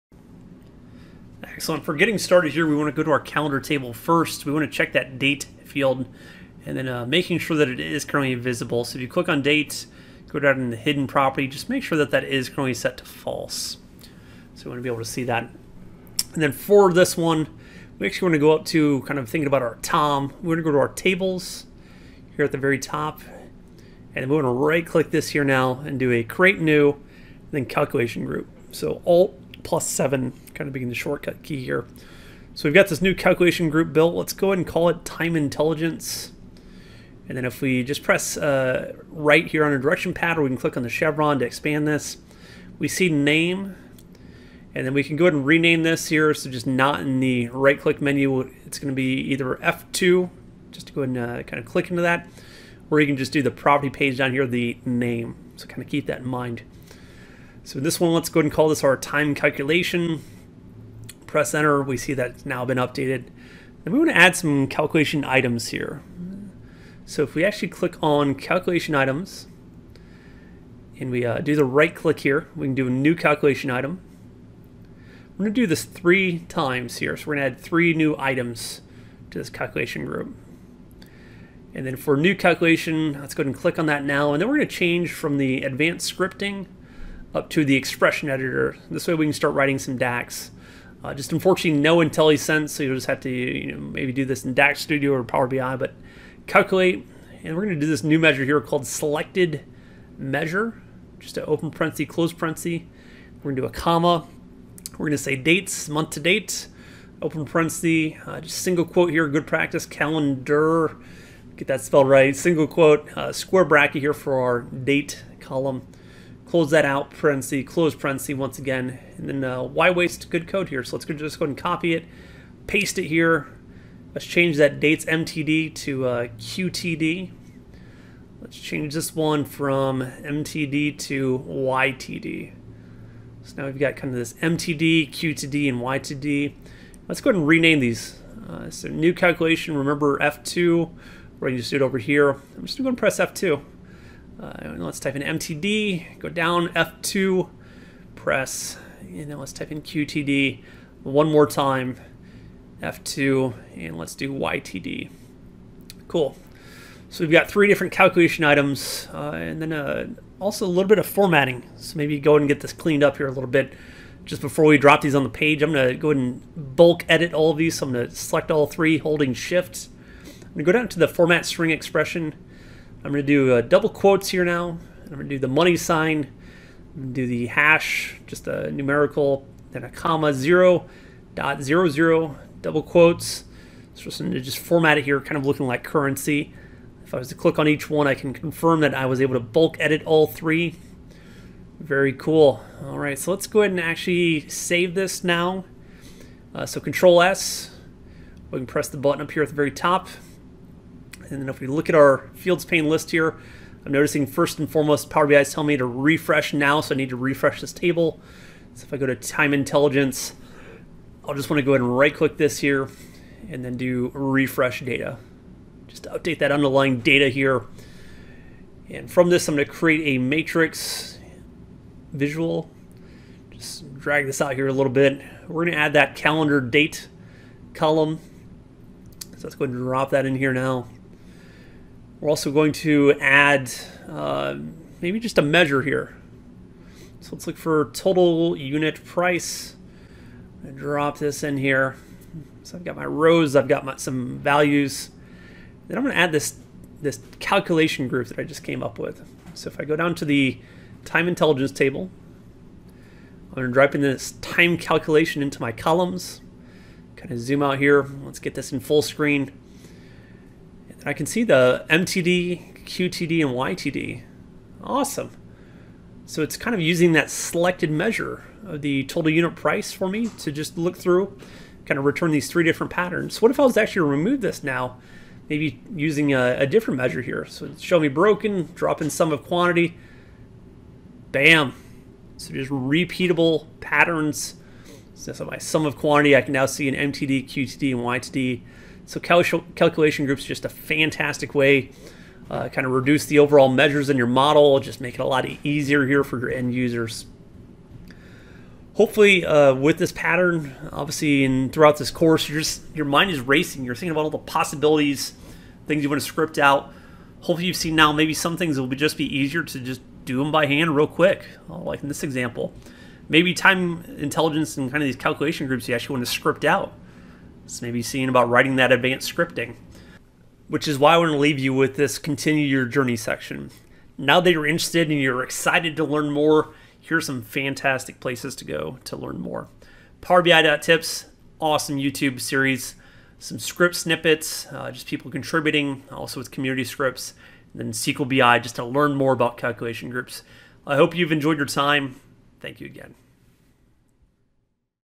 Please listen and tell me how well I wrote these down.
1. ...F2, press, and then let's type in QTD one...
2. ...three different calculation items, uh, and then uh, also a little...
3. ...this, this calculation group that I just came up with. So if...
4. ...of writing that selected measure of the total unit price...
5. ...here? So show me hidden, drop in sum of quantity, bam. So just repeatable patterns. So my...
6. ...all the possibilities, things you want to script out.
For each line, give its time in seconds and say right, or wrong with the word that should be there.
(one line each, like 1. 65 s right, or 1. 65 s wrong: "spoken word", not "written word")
1. 146 s right
2. 157 s right
3. 246 s right
4. 266 s wrong: "using", not "writing"
5. 277 s wrong: "broken", not "hidden"
6. 304 s right.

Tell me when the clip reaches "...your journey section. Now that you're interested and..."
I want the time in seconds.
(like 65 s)
322 s.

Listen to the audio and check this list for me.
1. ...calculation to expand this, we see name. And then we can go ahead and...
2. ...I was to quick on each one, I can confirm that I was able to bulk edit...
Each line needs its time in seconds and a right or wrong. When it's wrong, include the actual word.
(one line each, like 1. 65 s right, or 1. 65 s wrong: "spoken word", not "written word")
1. 40 s wrong: "chevron", not "calculation"
2. 187 s wrong: "click", not "quick".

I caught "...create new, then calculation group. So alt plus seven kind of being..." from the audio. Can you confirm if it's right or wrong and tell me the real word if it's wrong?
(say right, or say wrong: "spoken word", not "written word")
right.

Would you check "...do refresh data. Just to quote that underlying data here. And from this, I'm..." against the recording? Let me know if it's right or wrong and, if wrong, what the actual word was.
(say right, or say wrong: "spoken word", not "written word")
wrong: "update", not "quote".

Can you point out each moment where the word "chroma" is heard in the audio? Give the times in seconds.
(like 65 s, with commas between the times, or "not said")
not said.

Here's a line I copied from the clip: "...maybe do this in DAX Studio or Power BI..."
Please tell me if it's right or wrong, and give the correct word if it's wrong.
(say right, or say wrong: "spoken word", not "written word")
right.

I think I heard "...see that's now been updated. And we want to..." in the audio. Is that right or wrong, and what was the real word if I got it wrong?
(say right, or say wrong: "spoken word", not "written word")
right.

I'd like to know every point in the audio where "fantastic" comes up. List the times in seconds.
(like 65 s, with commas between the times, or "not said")
290 s, 327 s.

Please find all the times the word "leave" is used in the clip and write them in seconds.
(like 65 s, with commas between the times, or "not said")
321 s.